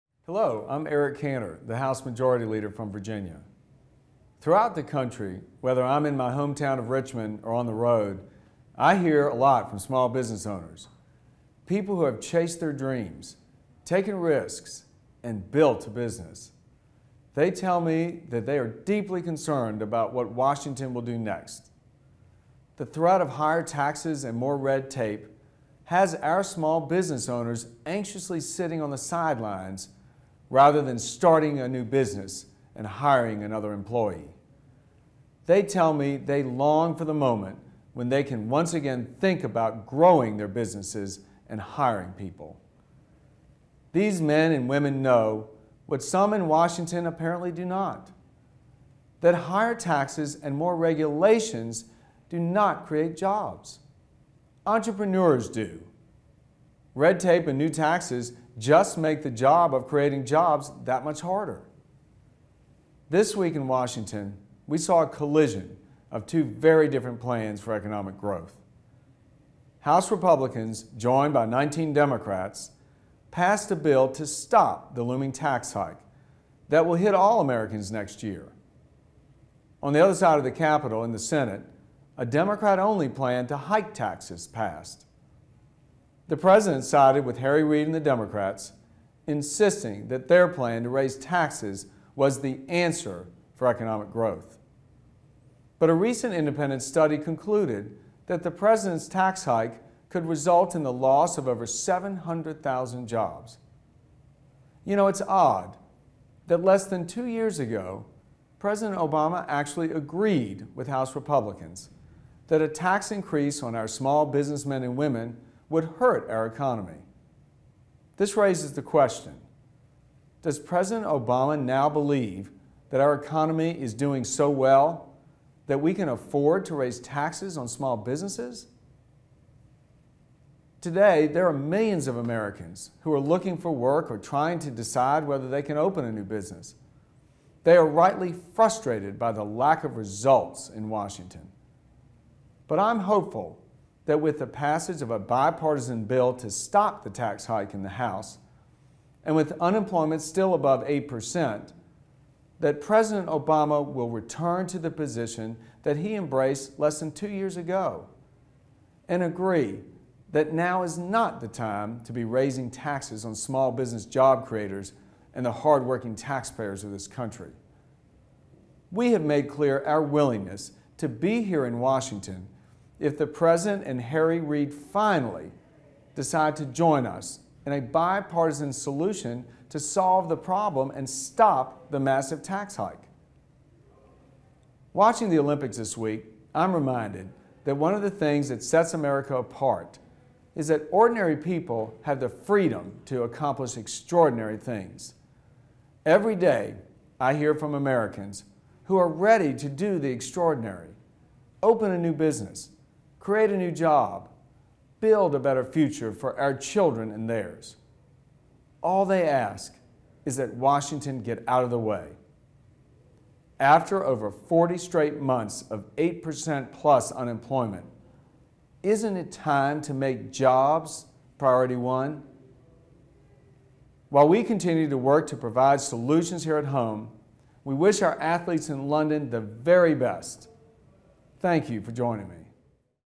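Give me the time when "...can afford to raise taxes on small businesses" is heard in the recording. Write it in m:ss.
2:05.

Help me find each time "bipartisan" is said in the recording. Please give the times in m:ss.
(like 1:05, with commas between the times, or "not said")
2:25, 2:57.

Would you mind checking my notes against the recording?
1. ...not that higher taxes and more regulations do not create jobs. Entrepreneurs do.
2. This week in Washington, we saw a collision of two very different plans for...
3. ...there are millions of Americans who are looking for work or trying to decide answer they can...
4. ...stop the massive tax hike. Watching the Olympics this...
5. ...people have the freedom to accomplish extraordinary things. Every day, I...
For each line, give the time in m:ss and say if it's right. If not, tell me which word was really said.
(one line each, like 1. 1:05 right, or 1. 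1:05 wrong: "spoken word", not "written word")
1. 0:47 right
2. 1:03 right
3. 2:11 wrong: "whether", not "answer"
4. 3:01 right
5. 3:11 right.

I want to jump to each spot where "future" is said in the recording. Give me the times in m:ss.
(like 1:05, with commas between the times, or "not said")
3:25.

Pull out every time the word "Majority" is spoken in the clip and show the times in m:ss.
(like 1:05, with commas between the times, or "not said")
0:02.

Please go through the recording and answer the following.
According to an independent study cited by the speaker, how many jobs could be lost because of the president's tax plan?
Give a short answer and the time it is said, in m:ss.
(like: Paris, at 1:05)
over 700,000, at 1:41.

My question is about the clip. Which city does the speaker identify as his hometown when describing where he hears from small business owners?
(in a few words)
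Richmond.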